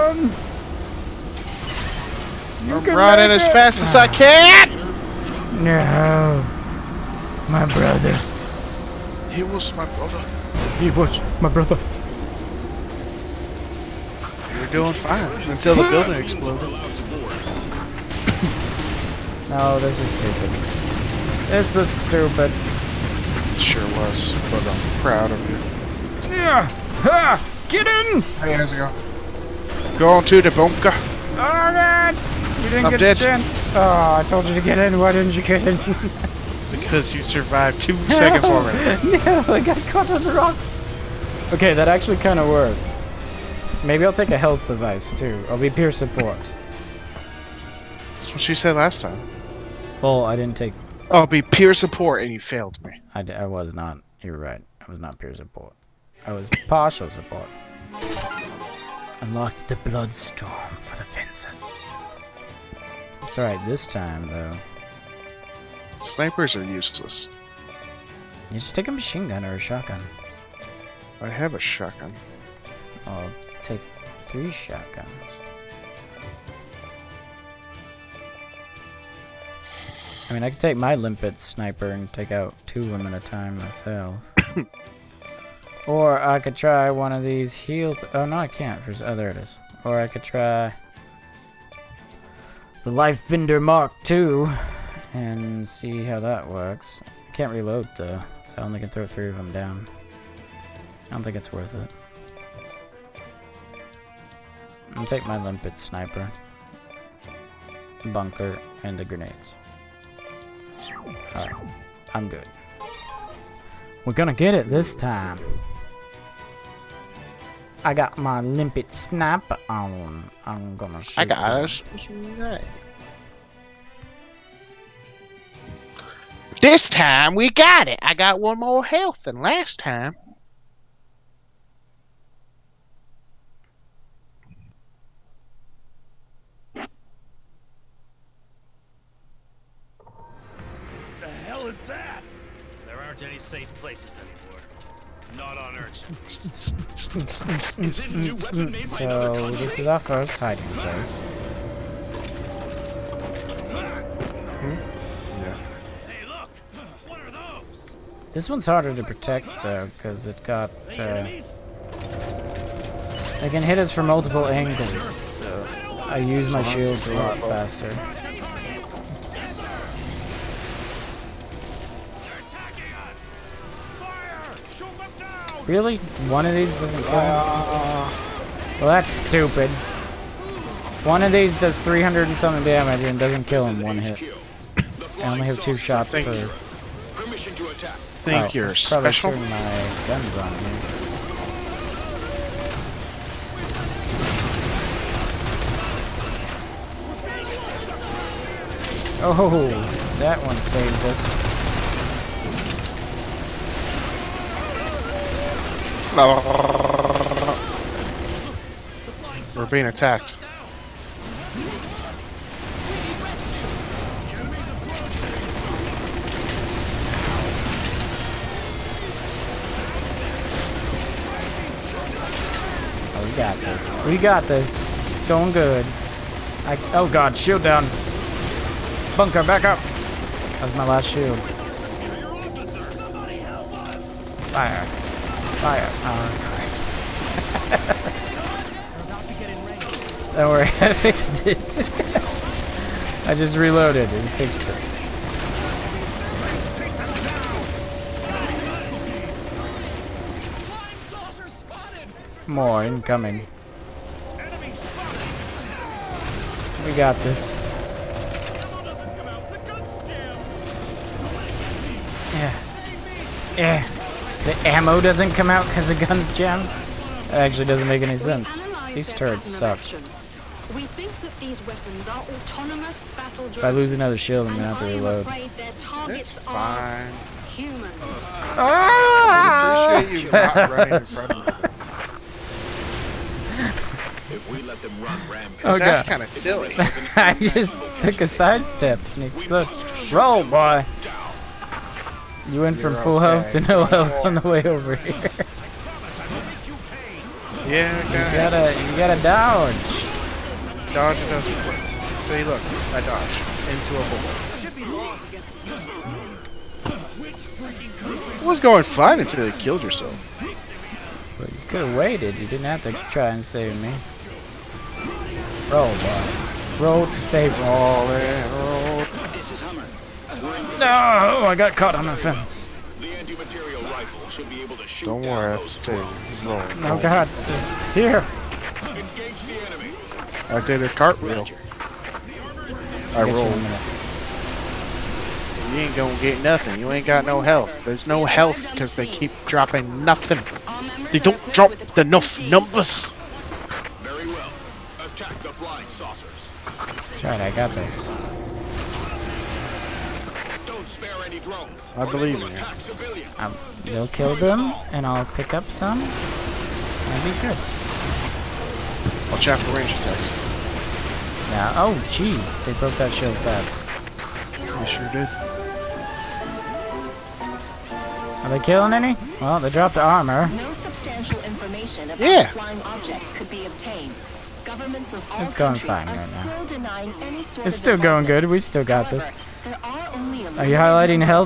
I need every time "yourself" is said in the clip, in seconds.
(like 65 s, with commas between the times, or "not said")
309 s.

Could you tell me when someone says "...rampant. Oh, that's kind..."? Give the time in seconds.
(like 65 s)
285 s.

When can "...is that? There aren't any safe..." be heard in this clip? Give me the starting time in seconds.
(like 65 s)
141 s.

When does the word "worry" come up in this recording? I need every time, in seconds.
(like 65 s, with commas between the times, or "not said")
240 s, 325 s.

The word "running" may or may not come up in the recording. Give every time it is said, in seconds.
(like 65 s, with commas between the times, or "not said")
2 s, 280 s.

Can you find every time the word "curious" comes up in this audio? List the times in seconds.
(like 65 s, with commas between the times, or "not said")
not said.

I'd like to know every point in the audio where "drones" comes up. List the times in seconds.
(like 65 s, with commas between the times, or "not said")
325 s, 351 s.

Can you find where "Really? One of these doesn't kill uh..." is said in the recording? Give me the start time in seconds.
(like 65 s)
175 s.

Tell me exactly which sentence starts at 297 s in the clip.
Yeah, you gotta, you gotta dodge.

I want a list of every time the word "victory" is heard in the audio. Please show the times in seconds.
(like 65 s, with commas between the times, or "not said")
not said.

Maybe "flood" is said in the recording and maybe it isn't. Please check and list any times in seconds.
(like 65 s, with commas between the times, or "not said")
not said.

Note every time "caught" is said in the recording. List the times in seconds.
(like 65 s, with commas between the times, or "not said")
39 s, 321 s.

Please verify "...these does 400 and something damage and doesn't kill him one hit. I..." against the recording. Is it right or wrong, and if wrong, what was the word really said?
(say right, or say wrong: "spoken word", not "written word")
wrong: "300", not "400".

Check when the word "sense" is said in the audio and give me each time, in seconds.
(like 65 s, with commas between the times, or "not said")
268 s.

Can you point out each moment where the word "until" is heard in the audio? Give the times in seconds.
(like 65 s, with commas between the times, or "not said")
15 s, 309 s.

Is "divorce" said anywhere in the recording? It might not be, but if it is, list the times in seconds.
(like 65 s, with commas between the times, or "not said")
not said.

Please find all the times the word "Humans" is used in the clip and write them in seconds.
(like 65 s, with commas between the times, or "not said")
277 s.